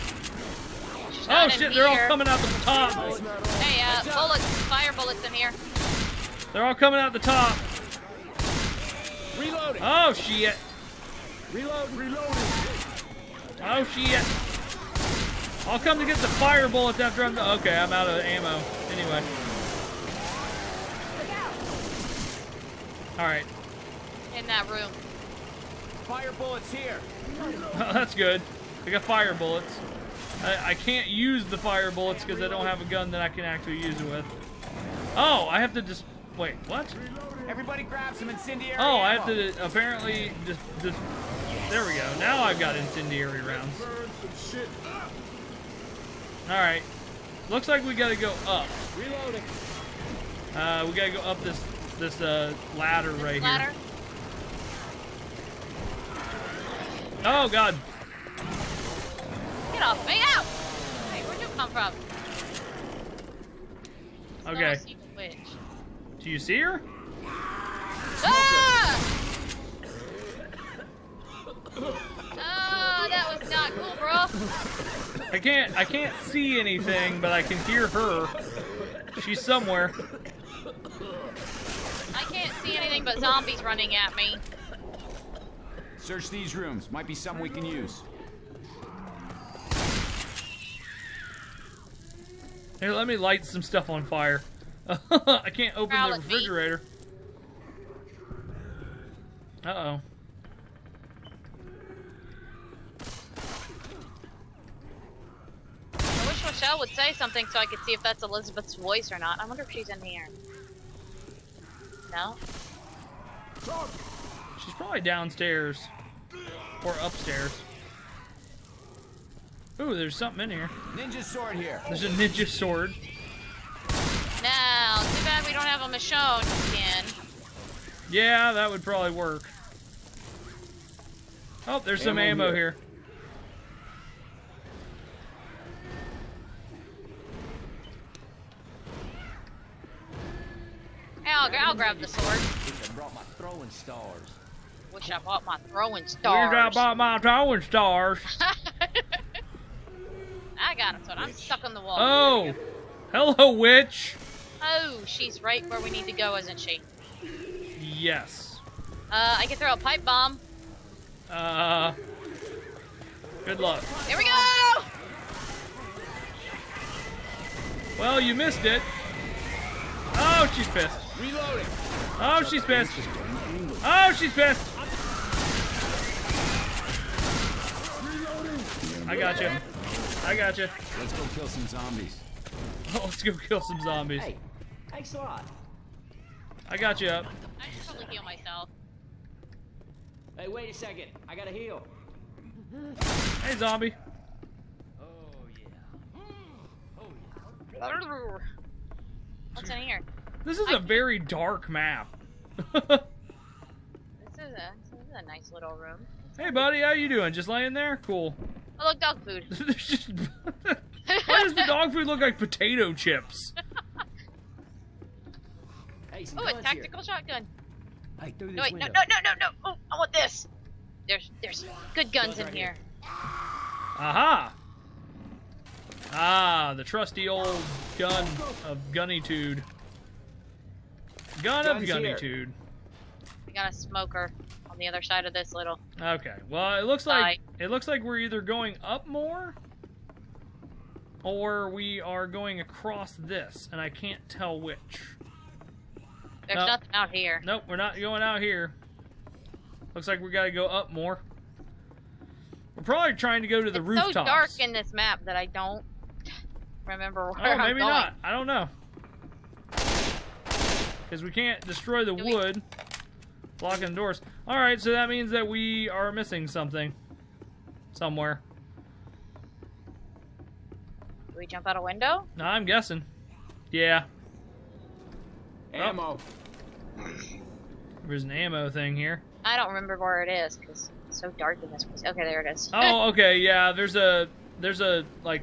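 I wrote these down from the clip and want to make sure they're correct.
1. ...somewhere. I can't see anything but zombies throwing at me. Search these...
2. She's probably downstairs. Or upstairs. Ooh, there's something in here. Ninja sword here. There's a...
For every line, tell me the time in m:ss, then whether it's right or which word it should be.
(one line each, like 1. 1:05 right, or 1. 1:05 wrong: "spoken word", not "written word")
1. 1:19 wrong: "running", not "throwing"
2. 1:54 right.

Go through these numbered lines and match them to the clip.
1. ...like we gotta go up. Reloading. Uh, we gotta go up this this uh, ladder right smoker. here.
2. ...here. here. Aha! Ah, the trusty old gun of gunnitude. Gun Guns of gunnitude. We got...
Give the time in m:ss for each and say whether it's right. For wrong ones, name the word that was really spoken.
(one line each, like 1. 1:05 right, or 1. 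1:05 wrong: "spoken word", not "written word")
1. 0:47 wrong: "ladder", not "smoker"
2. 3:42 right.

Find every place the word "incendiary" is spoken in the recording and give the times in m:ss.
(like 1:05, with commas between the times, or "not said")
0:38, 0:42.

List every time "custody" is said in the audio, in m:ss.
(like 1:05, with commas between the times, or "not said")
not said.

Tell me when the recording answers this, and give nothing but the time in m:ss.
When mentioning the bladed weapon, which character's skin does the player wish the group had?
2:05.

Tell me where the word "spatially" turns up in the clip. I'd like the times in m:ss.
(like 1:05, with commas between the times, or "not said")
not said.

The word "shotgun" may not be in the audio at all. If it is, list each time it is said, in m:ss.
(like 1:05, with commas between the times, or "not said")
3:37.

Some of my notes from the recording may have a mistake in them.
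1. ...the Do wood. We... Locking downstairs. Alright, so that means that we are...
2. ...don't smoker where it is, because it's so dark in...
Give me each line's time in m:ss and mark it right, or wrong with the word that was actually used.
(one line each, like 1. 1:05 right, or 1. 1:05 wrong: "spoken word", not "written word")
1. 4:22 wrong: "doors", not "downstairs"
2. 4:39 wrong: "remember", not "smoker".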